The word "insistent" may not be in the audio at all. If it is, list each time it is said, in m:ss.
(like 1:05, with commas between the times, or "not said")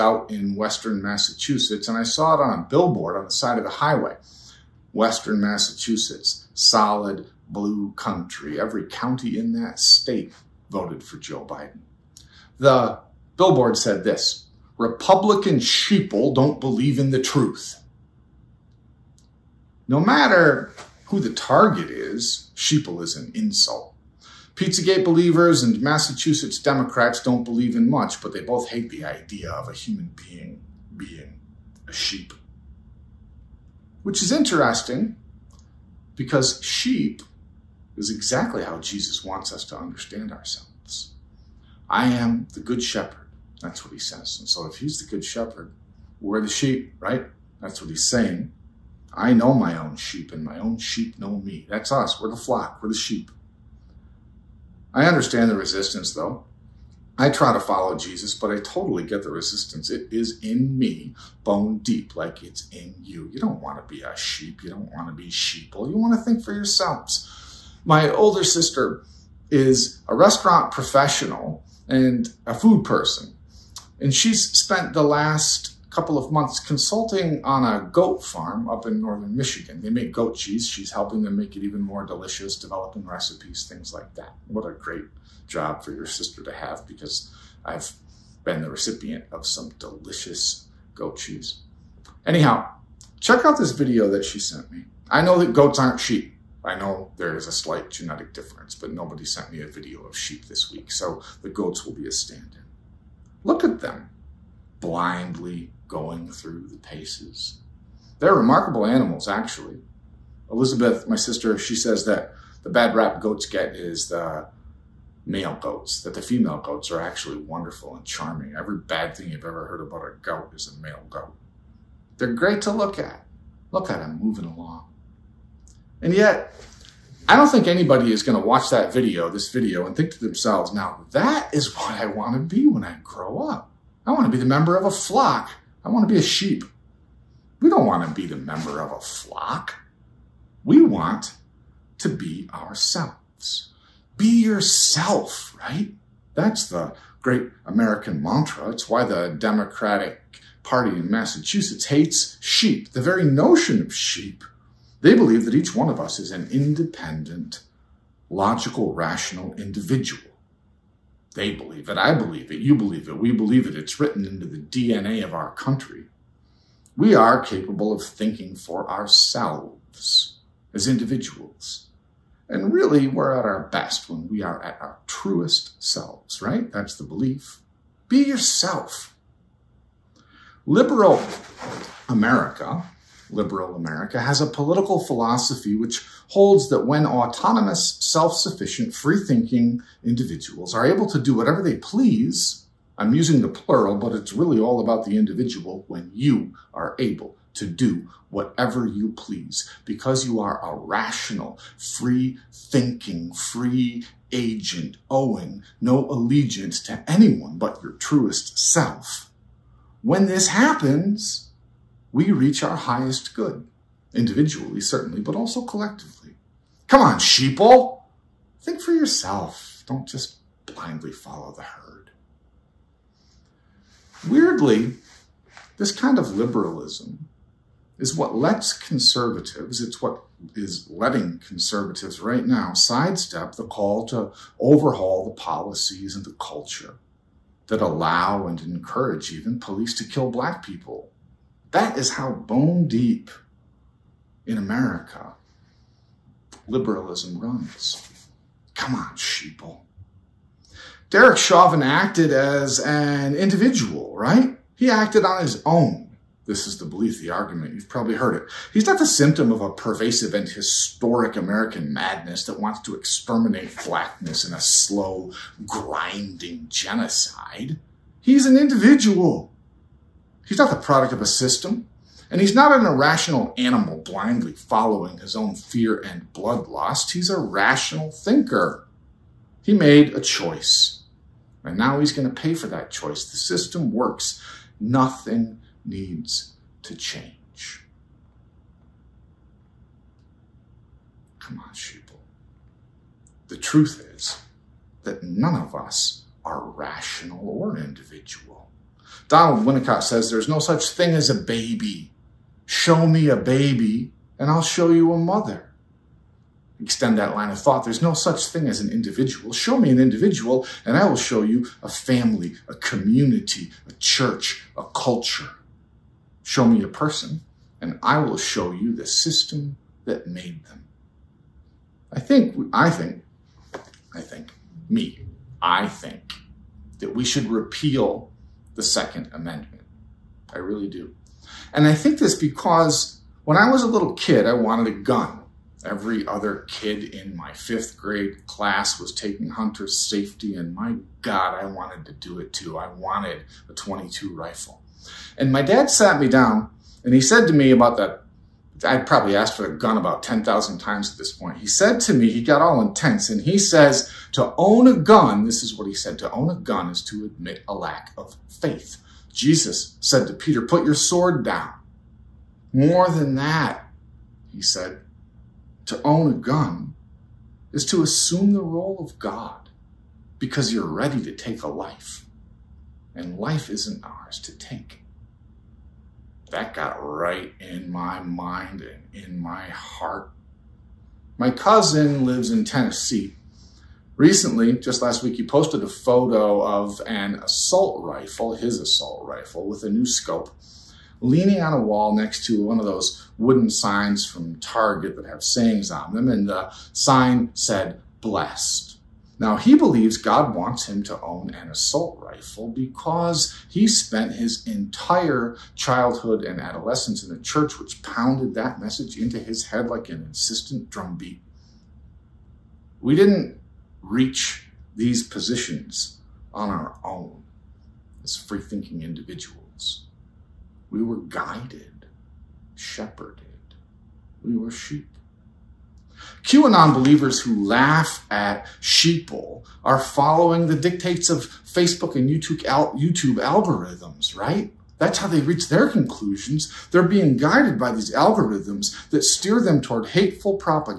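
6:50.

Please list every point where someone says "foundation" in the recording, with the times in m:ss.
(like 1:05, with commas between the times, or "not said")
not said.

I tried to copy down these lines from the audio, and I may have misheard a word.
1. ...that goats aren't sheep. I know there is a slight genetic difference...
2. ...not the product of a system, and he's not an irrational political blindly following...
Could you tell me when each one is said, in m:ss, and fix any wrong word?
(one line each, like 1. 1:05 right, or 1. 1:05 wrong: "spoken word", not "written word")
1. 1:35 right
2. 4:30 wrong: "animal", not "political".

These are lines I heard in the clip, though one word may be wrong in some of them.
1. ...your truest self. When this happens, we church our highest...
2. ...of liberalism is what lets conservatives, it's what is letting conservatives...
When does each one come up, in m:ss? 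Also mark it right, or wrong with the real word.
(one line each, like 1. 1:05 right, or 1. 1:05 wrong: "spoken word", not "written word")
1. 3:27 wrong: "reach", not "church"
2. 3:46 right.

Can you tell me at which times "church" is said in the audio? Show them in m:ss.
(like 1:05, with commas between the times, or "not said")
5:13, 6:47.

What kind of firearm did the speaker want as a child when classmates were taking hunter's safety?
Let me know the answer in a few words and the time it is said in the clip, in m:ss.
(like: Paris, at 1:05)
22 rifle, at 5:43.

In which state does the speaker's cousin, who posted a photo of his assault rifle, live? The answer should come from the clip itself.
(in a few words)
Tennessee.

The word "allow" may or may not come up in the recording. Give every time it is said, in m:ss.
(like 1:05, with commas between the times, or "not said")
3:57.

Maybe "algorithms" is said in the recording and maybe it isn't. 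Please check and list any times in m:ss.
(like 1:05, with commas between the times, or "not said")
7:13, 7:18.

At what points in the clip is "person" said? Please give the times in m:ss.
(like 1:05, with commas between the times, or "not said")
1:12, 5:16.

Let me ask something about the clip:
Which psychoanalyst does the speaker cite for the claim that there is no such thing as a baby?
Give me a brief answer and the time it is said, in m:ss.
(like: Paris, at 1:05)
Donald Winnicott, at 4:59.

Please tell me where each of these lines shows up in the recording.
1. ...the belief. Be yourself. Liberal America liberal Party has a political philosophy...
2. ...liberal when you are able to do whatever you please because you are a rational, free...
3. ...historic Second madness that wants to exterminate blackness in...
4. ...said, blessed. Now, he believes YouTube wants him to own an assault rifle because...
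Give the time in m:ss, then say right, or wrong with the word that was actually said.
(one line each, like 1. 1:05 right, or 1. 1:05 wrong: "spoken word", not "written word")
1. 2:56 wrong: "America", not "Party"
2. 3:15 wrong: "individual", not "liberal"
3. 4:20 wrong: "American", not "Second"
4. 6:37 wrong: "God", not "YouTube".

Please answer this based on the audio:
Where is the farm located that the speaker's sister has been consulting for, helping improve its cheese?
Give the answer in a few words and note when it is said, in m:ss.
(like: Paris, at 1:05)
northern Michigan, at 1:18.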